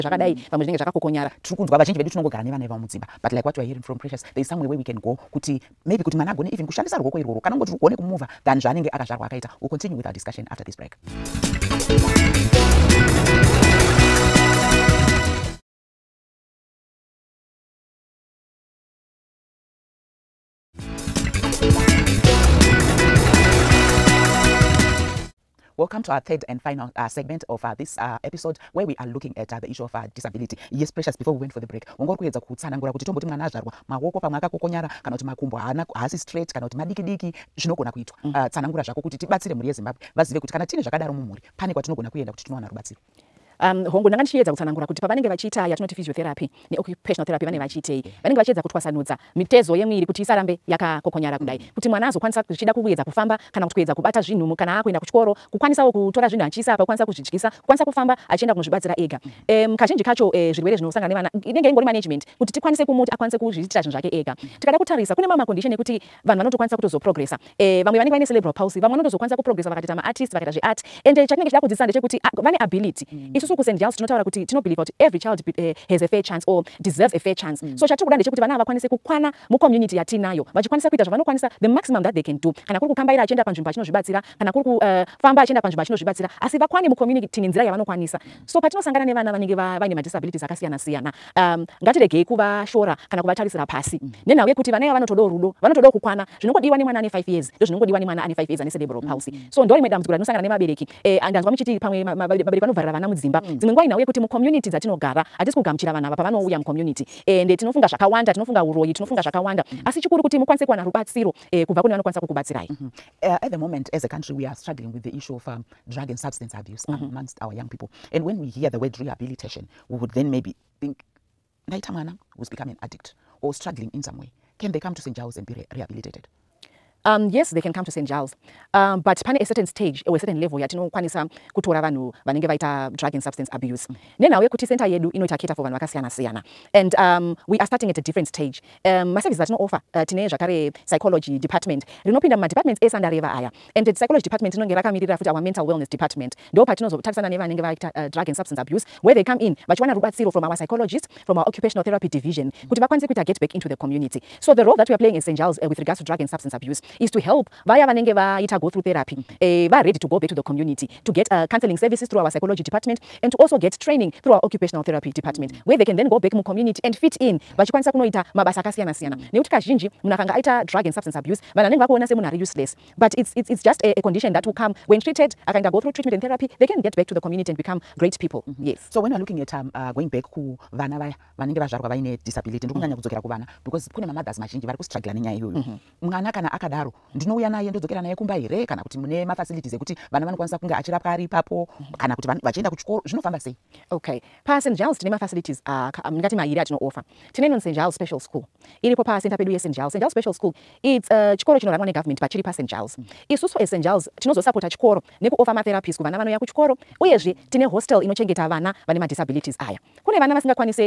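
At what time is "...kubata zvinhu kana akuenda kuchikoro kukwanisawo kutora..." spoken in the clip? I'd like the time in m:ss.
0:53.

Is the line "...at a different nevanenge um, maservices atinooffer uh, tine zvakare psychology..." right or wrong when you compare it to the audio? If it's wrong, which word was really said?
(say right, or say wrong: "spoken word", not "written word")
wrong: "stage", not "nevanenge".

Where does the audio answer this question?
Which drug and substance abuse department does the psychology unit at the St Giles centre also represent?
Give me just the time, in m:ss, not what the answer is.
2:25.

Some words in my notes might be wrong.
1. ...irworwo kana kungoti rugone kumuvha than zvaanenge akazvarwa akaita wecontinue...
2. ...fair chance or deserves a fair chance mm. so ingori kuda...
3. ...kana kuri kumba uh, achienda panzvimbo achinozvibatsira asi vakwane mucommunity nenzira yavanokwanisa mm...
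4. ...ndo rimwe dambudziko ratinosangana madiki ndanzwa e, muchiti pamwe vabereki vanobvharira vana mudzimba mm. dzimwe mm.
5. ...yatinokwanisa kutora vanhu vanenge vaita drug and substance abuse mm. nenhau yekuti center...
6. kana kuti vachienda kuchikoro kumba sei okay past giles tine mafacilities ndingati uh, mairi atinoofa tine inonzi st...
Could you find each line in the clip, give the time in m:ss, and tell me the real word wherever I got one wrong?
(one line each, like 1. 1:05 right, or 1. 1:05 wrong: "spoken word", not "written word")
1. 0:07 right
2. 1:16 wrong: "chatiri", not "ingori"
3. 1:24 wrong: "kufamba", not "kumba"
4. 1:39 wrong: "nevabereki", not "madiki"
5. 2:10 right
6. 3:11 wrong: "zvinofamba", not "kumba".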